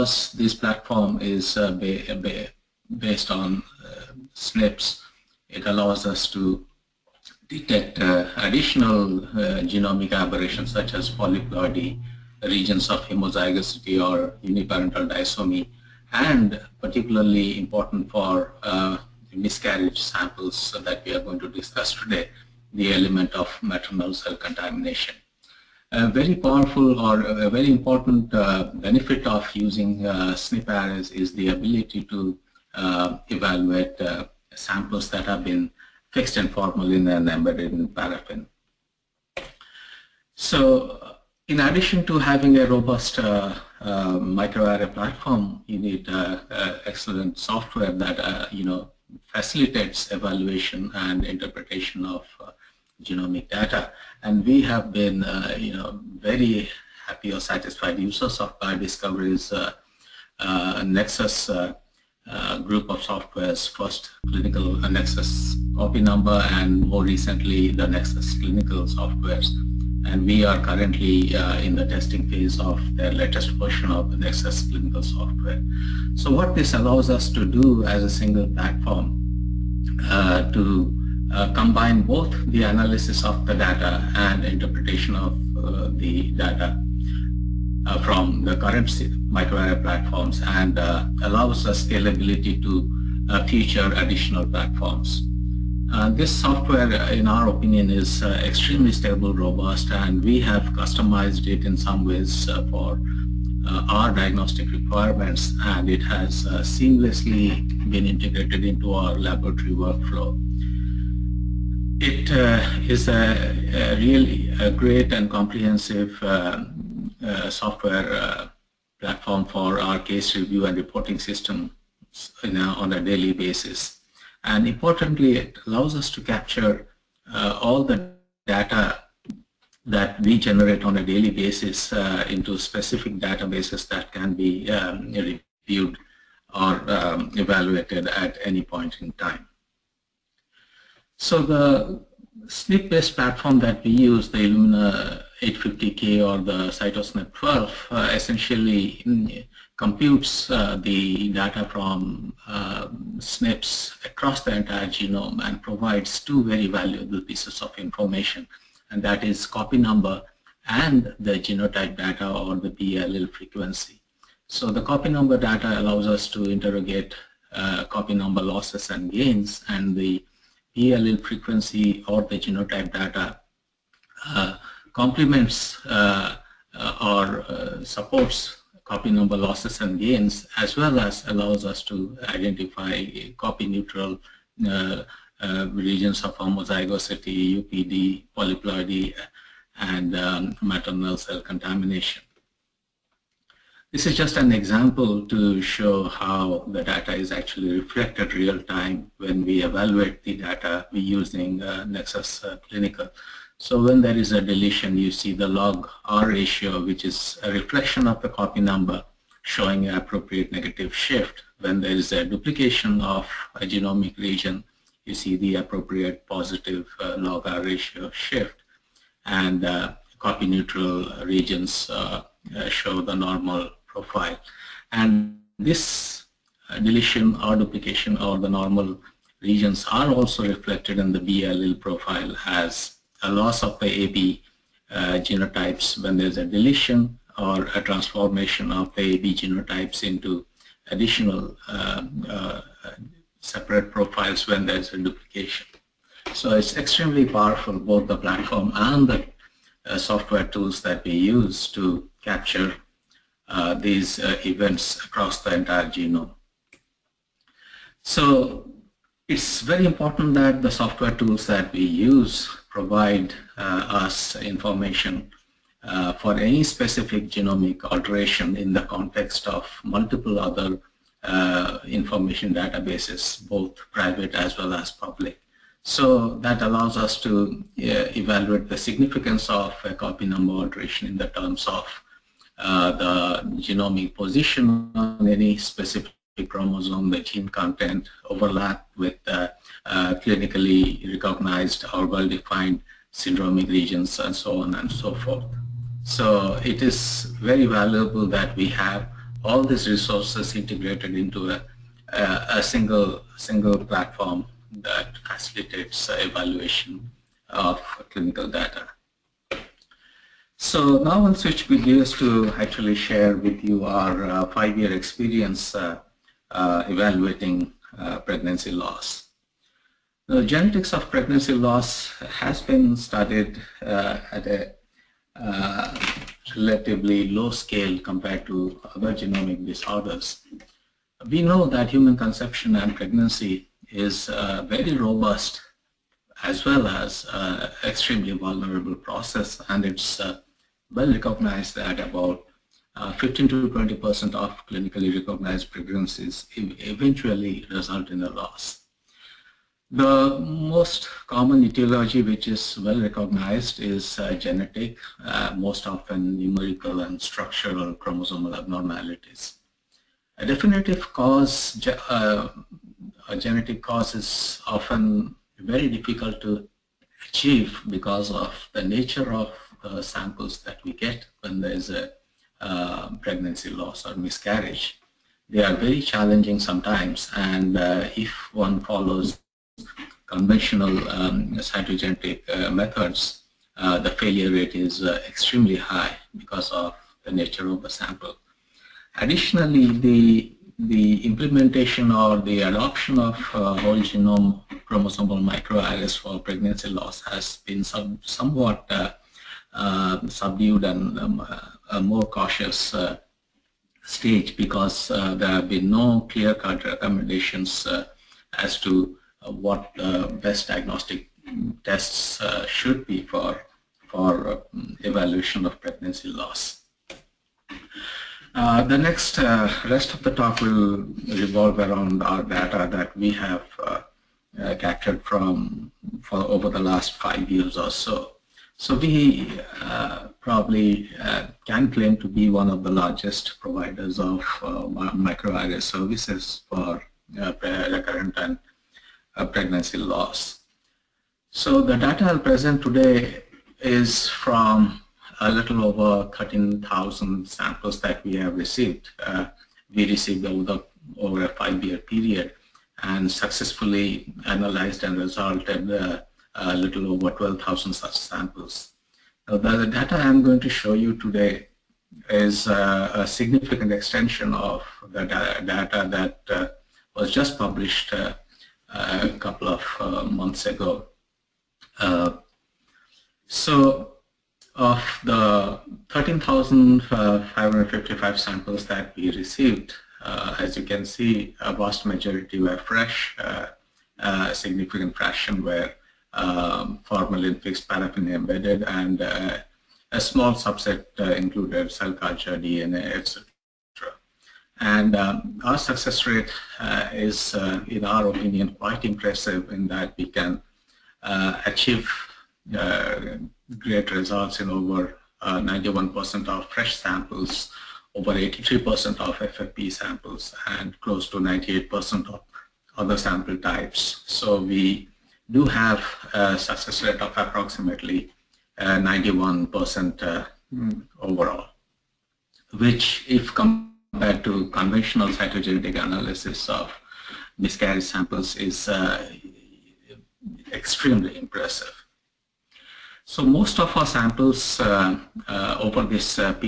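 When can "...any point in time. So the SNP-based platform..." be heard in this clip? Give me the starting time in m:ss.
2:18.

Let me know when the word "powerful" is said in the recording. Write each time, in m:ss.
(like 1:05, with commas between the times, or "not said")
0:26, 4:07.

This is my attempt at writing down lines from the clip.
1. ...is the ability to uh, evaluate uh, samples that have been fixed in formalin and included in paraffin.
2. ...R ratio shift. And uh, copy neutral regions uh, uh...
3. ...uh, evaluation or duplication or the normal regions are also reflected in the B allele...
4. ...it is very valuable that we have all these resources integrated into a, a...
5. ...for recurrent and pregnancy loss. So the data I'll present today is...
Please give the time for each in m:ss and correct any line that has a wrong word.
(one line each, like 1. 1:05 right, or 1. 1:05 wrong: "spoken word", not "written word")
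1. 0:31 wrong: "embedded", not "included"
2. 3:37 right
3. 3:46 wrong: "deletion", not "evaluation"
4. 4:56 right
5. 7:16 right.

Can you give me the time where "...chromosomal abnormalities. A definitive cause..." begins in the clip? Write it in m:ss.
5:57.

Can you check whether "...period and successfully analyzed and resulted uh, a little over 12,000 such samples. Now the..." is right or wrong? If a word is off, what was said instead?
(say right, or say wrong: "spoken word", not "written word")
right.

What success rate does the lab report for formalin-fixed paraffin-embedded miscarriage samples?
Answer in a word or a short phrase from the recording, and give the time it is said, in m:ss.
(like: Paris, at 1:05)
over 83%, at 8:28.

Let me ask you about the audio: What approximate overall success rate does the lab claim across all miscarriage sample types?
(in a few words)
91%.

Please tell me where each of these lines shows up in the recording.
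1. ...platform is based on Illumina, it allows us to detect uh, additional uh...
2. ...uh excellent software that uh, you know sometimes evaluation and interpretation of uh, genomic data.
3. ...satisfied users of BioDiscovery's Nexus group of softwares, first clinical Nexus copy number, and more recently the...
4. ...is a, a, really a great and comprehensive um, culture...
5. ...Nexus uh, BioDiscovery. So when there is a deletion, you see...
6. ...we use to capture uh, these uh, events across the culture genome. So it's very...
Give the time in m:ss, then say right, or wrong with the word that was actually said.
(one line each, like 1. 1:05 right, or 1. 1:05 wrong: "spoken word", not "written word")
1. 0:00 wrong: "SNPs", not "Illumina"
2. 0:46 wrong: "facilitates", not "sometimes"
3. 0:57 right
4. 1:52 wrong: "software", not "culture"
5. 3:21 wrong: "Clinical", not "BioDiscovery"
6. 4:11 wrong: "entire", not "culture".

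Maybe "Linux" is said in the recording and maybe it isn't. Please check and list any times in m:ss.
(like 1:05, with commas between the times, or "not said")
not said.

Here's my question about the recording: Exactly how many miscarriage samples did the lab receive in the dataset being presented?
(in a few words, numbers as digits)
13,555.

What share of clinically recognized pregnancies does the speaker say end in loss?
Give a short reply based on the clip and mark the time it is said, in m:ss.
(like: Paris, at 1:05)
15 to 20 percent, at 5:43.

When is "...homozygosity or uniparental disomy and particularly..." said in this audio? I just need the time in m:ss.
0:13.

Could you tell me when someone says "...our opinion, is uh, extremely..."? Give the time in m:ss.
1:37.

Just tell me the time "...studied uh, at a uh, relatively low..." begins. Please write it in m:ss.
5:22.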